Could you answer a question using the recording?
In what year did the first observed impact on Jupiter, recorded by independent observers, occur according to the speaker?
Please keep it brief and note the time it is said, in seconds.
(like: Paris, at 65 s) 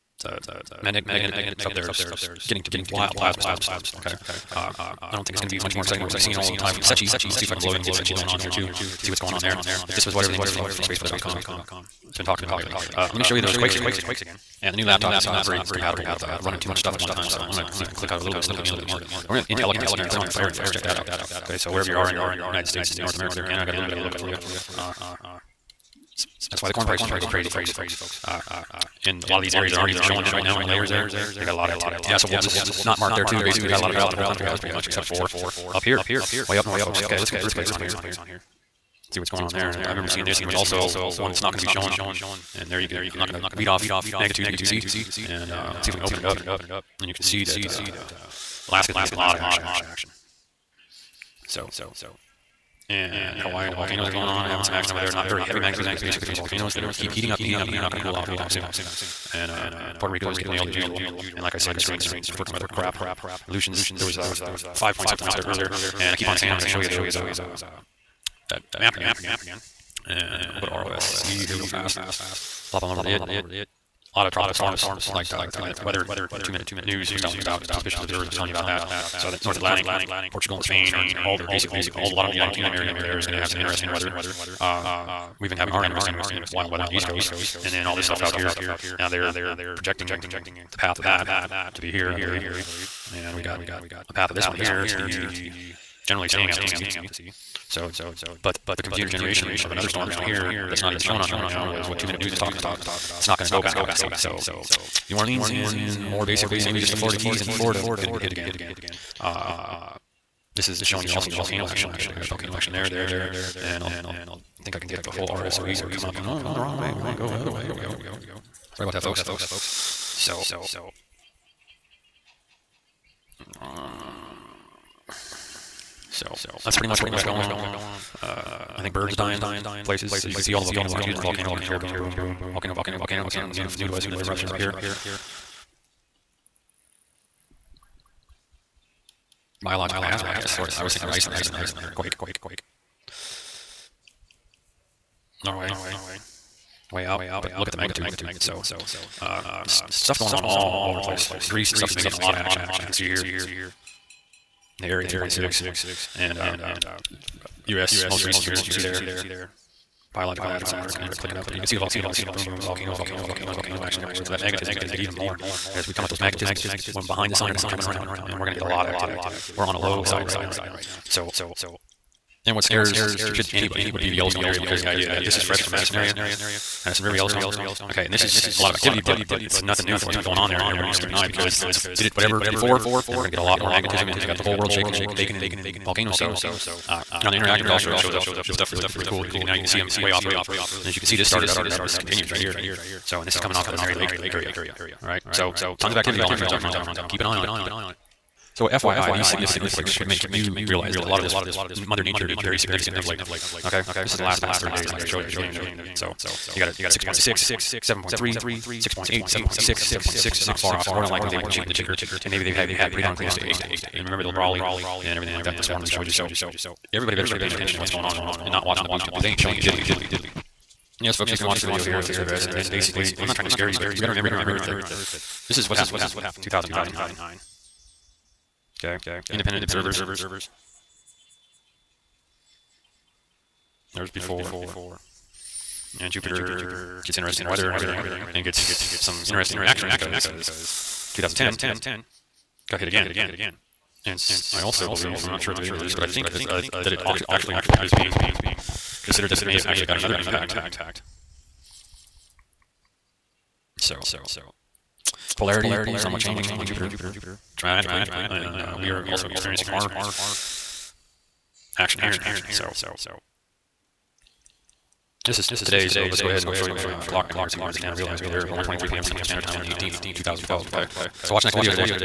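2009, at 226 s.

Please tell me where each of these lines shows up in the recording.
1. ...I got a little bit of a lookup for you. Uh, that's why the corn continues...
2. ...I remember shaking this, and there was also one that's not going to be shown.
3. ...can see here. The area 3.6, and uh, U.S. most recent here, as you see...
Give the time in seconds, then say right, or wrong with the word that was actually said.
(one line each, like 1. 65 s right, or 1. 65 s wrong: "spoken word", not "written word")
1. 23 s wrong: "prices", not "continues"
2. 39 s wrong: "seeing", not "shaking"
3. 152 s right.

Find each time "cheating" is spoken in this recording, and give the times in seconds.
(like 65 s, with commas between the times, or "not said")
211 s.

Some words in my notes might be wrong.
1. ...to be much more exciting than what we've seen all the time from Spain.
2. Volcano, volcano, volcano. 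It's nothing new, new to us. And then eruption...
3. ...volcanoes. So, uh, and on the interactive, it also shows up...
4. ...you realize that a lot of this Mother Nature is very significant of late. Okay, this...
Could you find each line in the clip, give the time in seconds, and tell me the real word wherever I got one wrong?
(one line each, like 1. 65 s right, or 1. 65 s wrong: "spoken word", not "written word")
1. 5 s wrong: "SECCHI", not "Spain"
2. 132 s right
3. 185 s right
4. 200 s right.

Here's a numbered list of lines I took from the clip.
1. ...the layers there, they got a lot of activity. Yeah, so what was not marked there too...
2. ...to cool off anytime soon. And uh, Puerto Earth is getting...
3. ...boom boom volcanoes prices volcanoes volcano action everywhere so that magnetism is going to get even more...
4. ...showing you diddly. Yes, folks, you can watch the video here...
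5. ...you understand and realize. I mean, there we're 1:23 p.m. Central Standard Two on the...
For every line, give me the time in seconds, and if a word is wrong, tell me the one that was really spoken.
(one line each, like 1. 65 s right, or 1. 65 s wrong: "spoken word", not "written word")
1. 30 s right
2. 57 s wrong: "Rico", not "Earth"
3. 162 s wrong: "volcanoes", not "prices"
4. 219 s right
5. 267 s wrong: "Time", not "Two".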